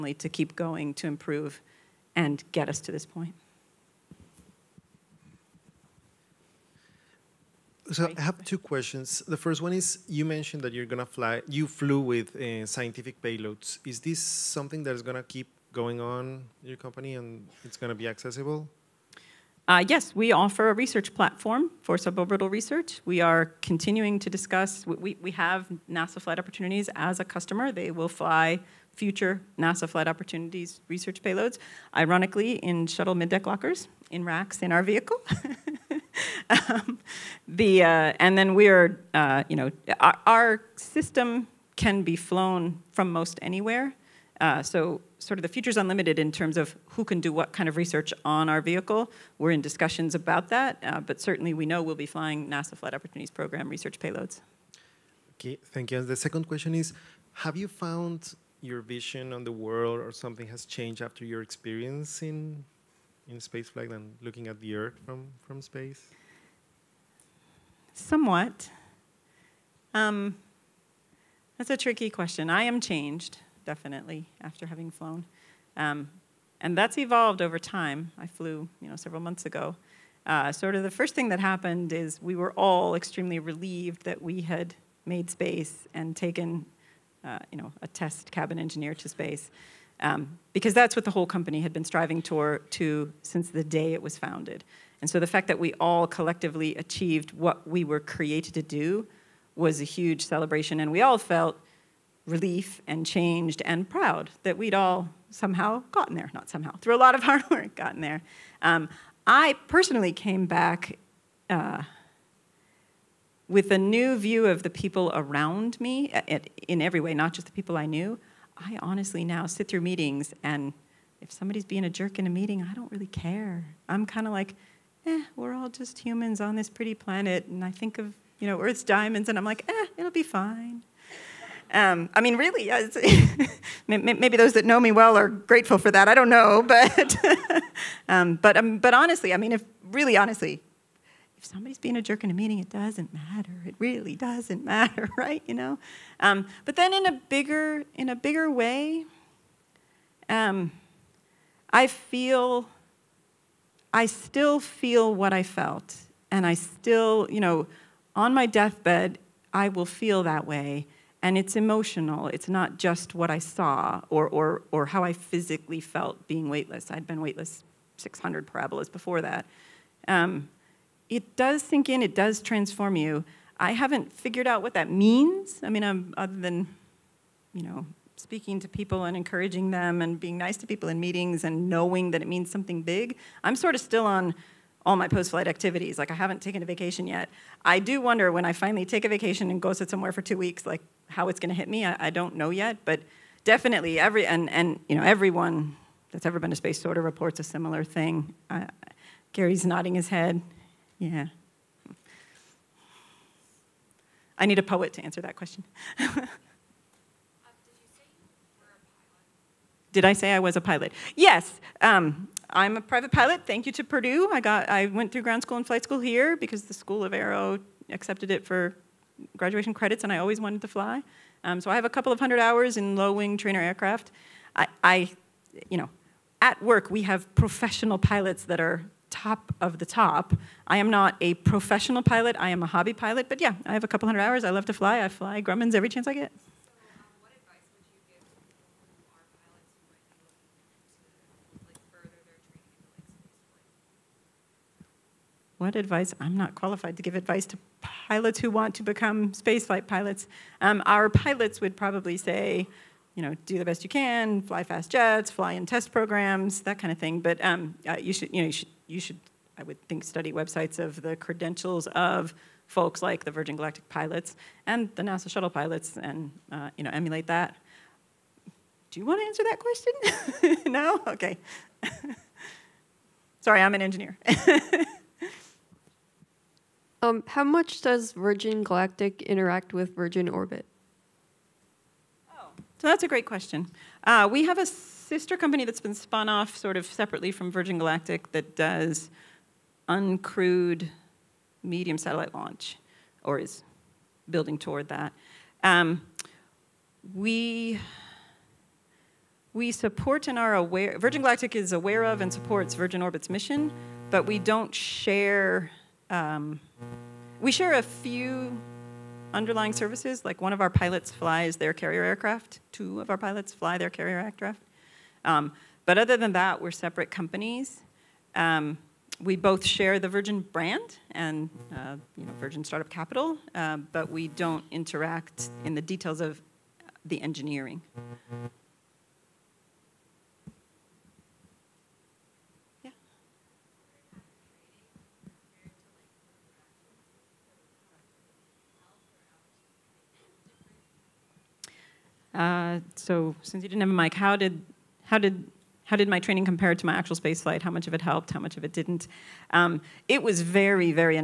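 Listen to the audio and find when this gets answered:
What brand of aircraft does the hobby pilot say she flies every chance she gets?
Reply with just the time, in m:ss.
3:55.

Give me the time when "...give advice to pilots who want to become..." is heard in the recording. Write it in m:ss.
4:07.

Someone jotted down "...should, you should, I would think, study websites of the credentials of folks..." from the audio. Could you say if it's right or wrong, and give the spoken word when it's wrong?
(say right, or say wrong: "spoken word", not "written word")
right.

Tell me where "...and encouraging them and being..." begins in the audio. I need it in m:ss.
2:59.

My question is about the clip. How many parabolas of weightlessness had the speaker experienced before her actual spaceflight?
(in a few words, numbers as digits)
600.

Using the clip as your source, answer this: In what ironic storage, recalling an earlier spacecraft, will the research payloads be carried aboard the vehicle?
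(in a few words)
Shuttle middeck lockers.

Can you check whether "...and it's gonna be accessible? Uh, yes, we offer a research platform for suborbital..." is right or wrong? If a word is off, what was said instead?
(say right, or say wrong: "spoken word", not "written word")
right.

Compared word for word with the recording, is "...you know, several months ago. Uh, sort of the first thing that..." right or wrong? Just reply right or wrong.
right.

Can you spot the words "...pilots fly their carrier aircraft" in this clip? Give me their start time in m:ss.
5:13.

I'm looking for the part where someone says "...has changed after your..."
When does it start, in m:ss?
1:00.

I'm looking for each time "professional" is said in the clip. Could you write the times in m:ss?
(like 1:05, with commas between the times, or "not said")
3:47, 3:51.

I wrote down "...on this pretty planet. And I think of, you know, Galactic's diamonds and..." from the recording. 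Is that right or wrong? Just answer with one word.
wrong.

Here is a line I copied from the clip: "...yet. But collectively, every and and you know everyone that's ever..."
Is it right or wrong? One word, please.
wrong.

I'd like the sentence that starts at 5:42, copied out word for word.
Uh, so since you didn't have a mic, how did, how did how did my training compare to my actual spaceflight?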